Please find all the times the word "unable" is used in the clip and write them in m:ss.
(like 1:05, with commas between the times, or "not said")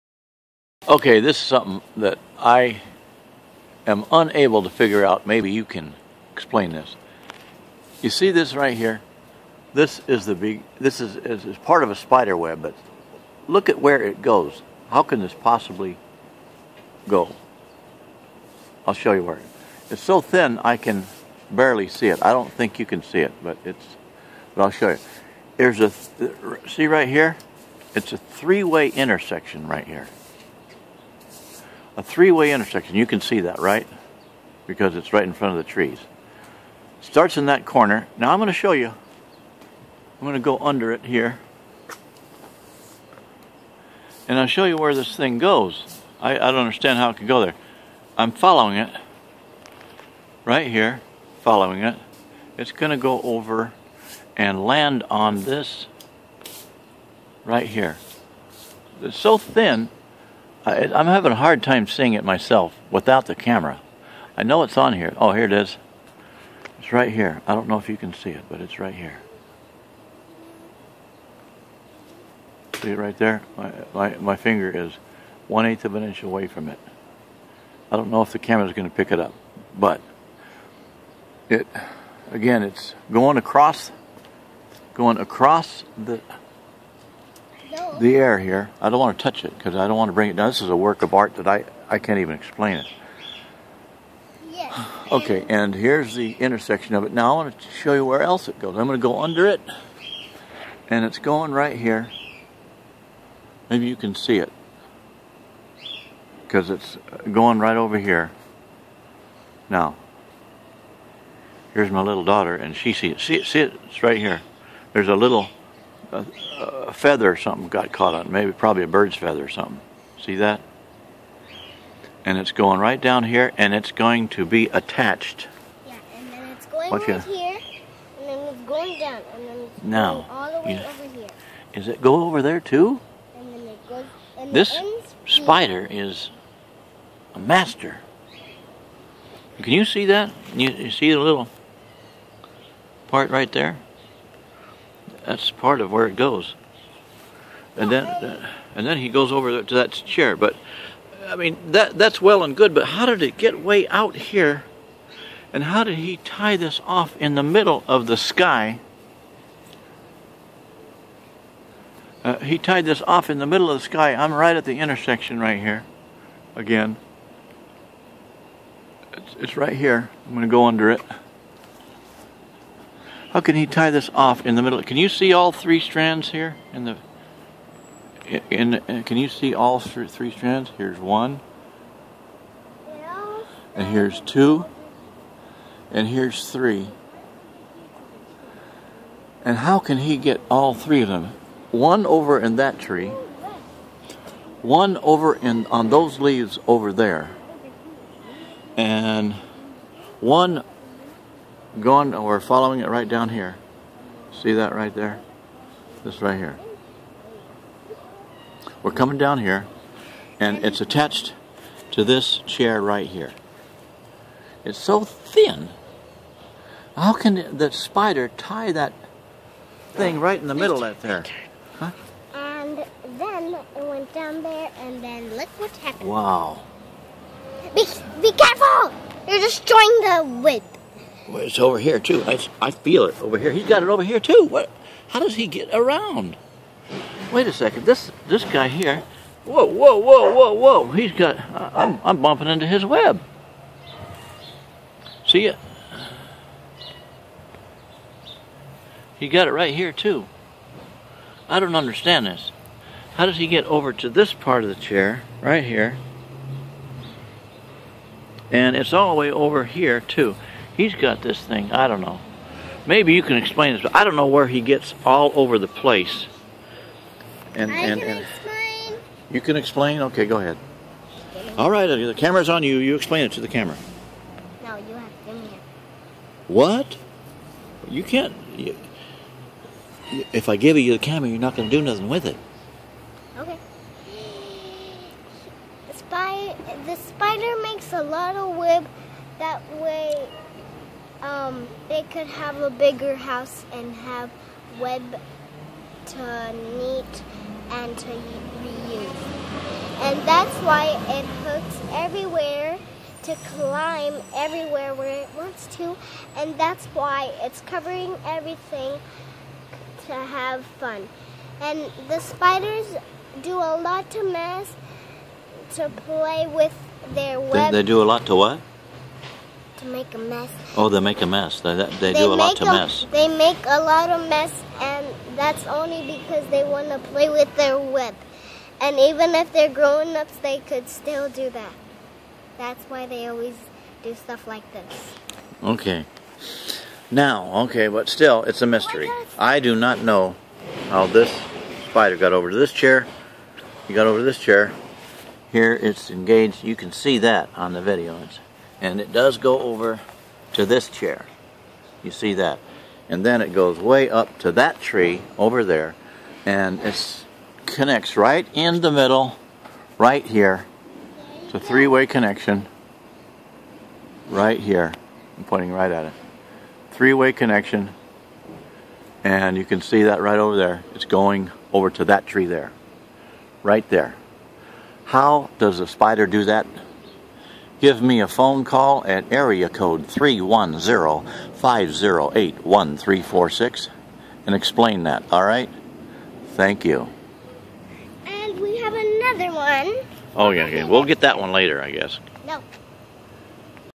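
0:04.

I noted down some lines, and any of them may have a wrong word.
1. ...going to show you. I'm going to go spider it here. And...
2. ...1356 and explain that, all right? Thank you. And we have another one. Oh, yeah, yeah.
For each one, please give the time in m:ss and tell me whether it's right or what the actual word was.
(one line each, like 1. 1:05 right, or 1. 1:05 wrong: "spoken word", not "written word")
1. 0:38 wrong: "under", not "spider"
2. 6:22 wrong: "1346", not "1356".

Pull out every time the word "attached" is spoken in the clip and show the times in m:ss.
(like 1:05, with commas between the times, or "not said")
2:04, 3:30.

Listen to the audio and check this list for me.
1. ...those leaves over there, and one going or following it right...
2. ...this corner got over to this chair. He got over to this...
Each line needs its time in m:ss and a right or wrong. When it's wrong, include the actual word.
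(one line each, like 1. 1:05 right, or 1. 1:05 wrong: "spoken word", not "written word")
1. 3:15 right
2. 5:41 wrong: "spider", not "corner".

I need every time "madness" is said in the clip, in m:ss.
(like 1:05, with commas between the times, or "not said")
not said.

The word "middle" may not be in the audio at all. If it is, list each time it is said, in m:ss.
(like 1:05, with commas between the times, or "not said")
2:37, 2:43, 2:54, 3:40, 5:58.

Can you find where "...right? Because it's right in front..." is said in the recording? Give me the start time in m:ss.
0:33.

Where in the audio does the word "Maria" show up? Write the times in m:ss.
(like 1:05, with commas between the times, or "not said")
not said.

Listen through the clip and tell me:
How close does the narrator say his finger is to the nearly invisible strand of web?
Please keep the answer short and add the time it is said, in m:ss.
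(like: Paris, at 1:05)
1/8 of an inch, at 1:15.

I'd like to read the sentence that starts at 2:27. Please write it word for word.
And then, and then he goes over to that chair.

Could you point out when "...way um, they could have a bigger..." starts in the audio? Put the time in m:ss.
4:49.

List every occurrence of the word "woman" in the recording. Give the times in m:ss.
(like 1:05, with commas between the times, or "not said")
not said.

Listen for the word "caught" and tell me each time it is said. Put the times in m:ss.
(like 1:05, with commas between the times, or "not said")
1:57.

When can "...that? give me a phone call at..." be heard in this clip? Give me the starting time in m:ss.
6:16.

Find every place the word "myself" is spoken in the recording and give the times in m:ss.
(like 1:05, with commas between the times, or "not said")
1:02.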